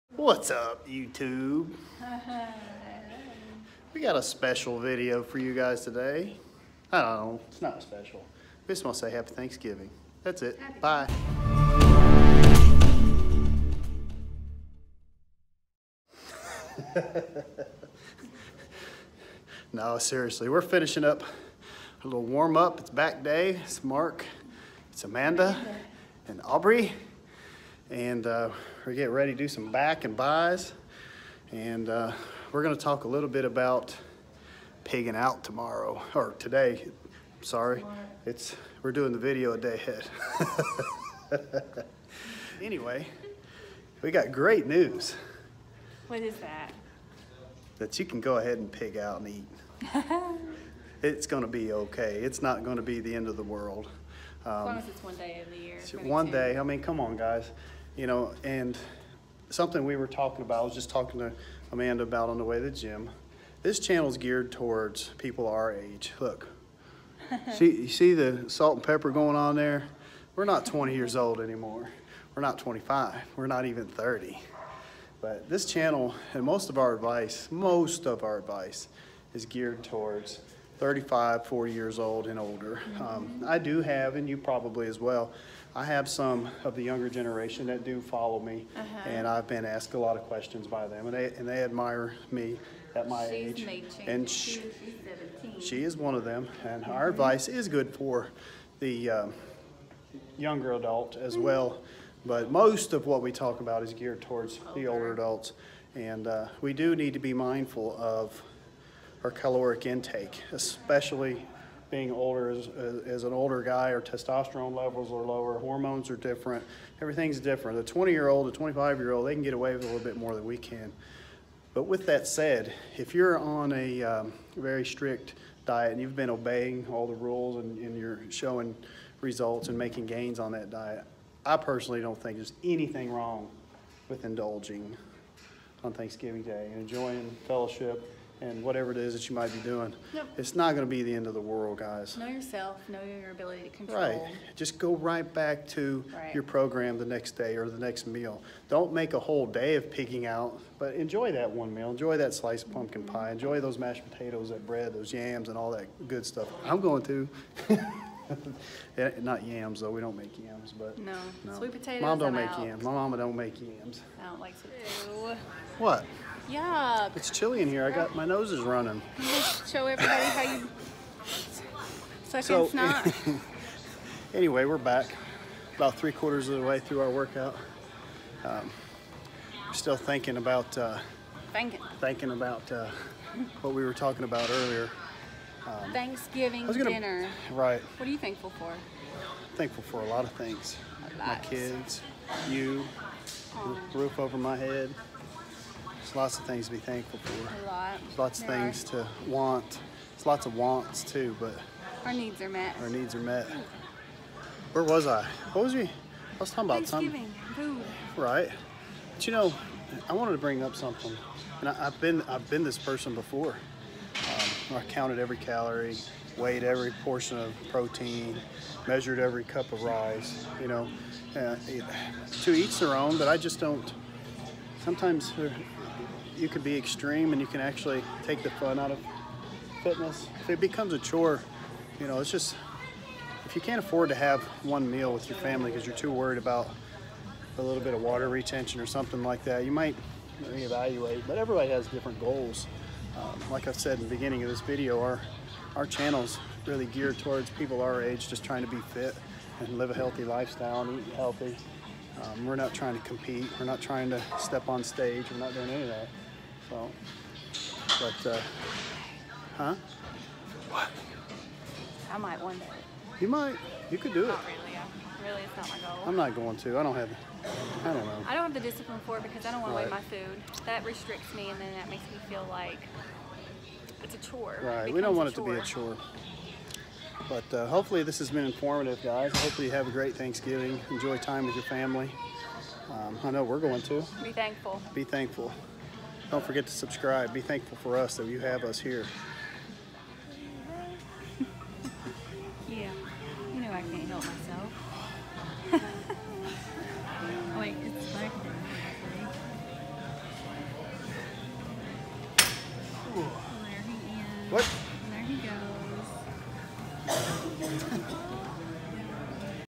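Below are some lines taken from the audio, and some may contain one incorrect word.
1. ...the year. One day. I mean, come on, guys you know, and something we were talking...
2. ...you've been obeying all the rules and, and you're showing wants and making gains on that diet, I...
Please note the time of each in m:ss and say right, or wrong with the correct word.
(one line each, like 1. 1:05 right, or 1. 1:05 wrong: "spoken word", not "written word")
1. 0:55 right
2. 2:06 wrong: "results", not "wants".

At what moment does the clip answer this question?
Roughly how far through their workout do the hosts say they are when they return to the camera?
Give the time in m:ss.
2:55.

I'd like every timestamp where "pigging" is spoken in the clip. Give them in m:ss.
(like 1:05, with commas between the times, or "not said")
0:34, 2:29.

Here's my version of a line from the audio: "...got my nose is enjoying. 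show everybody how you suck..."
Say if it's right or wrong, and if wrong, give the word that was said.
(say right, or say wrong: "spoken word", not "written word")
wrong: "running", not "enjoying".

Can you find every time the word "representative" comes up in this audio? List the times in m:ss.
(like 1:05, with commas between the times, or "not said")
not said.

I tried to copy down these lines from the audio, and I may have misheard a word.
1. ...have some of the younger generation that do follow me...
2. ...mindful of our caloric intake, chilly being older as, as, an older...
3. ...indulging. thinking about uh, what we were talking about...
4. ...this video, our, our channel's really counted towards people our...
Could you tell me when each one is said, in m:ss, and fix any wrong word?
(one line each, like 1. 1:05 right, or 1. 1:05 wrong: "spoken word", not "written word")
1. 1:25 right
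2. 1:47 wrong: "especially", not "chilly"
3. 3:01 wrong: "thinking", not "indulging"
4. 4:04 wrong: "geared", not "counted".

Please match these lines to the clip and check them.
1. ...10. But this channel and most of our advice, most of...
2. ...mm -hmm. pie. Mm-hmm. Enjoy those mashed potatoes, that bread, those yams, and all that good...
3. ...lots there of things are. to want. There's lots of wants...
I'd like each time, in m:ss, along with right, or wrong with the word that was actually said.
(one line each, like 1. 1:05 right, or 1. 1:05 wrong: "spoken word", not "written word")
1. 1:13 wrong: "30", not "10"
2. 2:33 right
3. 3:18 right.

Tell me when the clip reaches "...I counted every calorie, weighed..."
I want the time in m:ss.
3:34.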